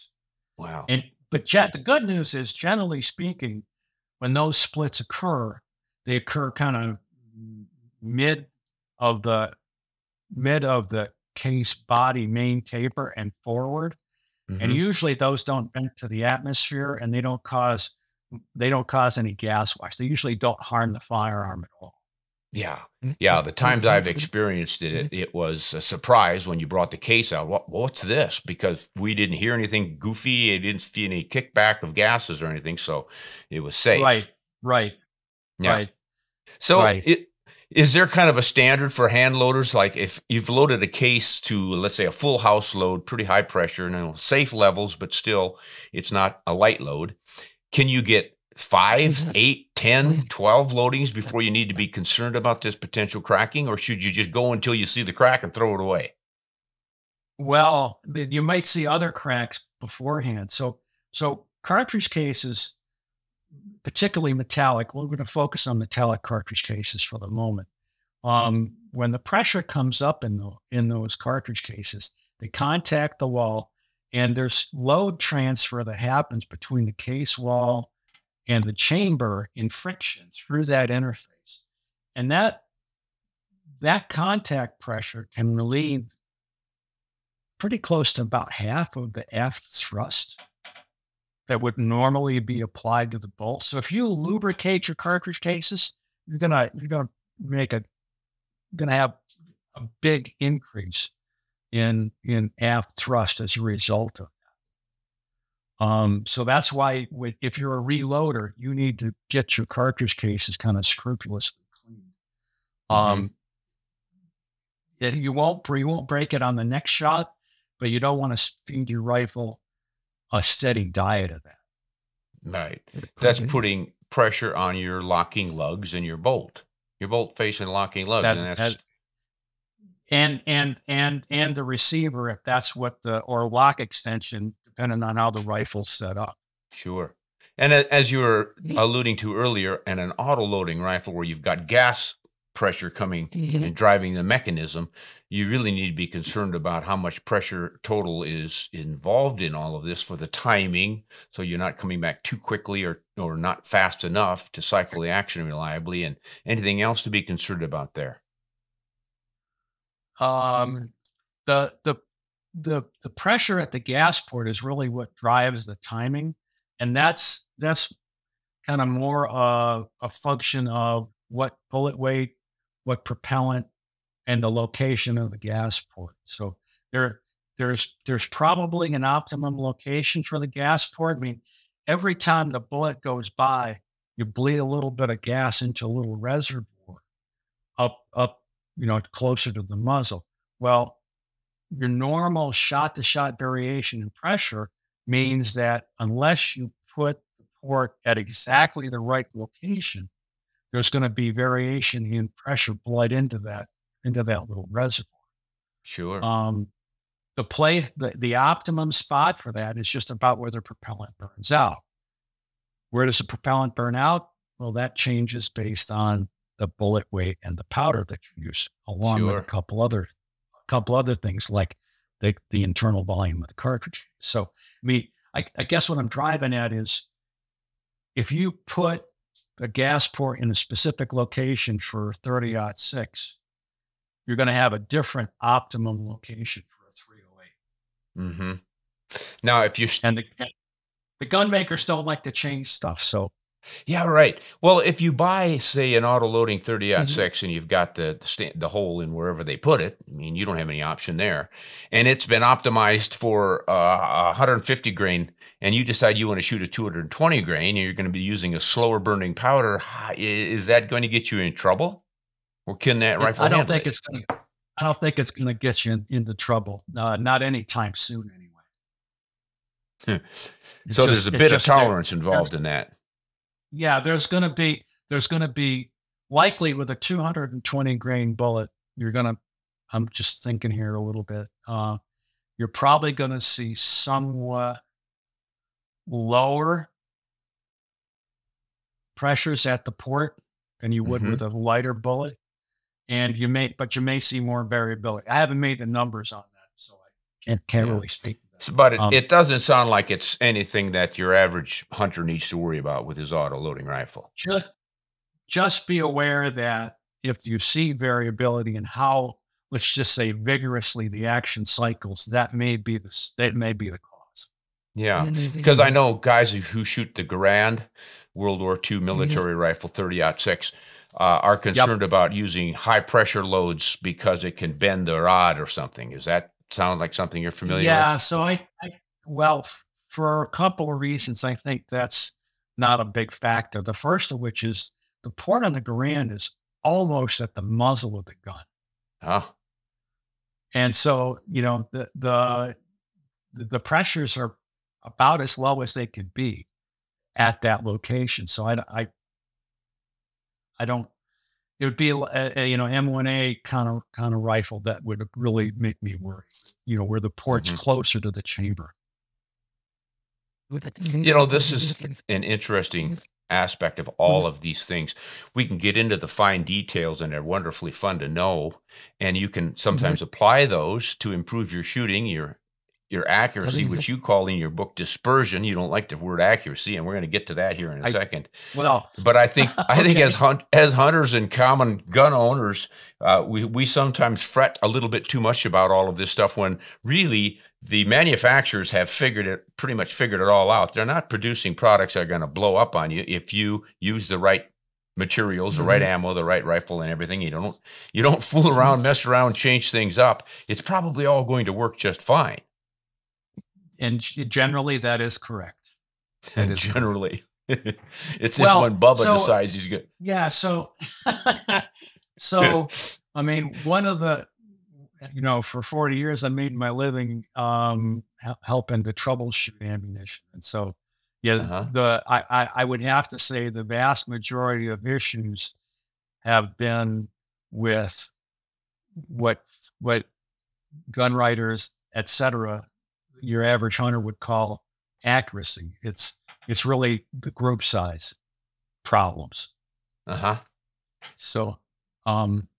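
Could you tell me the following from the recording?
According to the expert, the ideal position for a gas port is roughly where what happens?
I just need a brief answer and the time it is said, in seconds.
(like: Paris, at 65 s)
the propellant burns out, at 210 s.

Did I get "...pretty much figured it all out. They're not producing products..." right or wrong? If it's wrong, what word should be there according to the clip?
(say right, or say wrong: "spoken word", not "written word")
right.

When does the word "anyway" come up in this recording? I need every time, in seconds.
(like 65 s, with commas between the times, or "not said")
268 s.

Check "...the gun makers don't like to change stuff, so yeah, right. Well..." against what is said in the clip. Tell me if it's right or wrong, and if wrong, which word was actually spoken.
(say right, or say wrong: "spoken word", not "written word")
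right.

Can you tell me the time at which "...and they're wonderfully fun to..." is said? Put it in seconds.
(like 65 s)
367 s.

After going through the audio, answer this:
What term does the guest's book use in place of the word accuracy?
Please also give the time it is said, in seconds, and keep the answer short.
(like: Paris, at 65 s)
dispersion, at 374 s.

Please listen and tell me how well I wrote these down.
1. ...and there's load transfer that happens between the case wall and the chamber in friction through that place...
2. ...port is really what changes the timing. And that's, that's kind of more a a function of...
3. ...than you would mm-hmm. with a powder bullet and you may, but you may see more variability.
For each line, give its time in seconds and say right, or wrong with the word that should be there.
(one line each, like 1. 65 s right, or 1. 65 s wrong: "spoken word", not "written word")
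1. 74 s wrong: "interface", not "place"
2. 164 s wrong: "drives", not "changes"
3. 290 s wrong: "lighter", not "powder".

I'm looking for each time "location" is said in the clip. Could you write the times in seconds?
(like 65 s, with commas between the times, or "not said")
174 s, 179 s, 199 s, 231 s, 236 s, 347 s.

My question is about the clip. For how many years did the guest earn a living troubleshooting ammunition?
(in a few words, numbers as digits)
40.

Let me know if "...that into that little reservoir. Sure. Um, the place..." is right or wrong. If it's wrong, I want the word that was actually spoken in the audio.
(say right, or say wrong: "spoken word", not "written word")
right.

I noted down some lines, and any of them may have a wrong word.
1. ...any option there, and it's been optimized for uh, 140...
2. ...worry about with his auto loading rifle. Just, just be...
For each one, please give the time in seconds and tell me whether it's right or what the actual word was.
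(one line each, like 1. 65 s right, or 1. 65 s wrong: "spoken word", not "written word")
1. 250 s wrong: "150", not "140"
2. 302 s right.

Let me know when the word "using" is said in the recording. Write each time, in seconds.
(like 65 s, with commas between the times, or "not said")
258 s, 322 s.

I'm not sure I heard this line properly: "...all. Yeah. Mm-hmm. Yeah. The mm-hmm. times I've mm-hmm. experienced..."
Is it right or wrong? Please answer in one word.
right.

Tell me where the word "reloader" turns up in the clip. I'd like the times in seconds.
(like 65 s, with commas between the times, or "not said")
107 s.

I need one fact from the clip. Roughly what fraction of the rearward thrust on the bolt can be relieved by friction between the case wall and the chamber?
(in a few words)
about half.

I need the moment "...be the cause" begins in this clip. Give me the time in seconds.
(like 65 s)
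313 s.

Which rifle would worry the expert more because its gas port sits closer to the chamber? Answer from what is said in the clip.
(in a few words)
M1A.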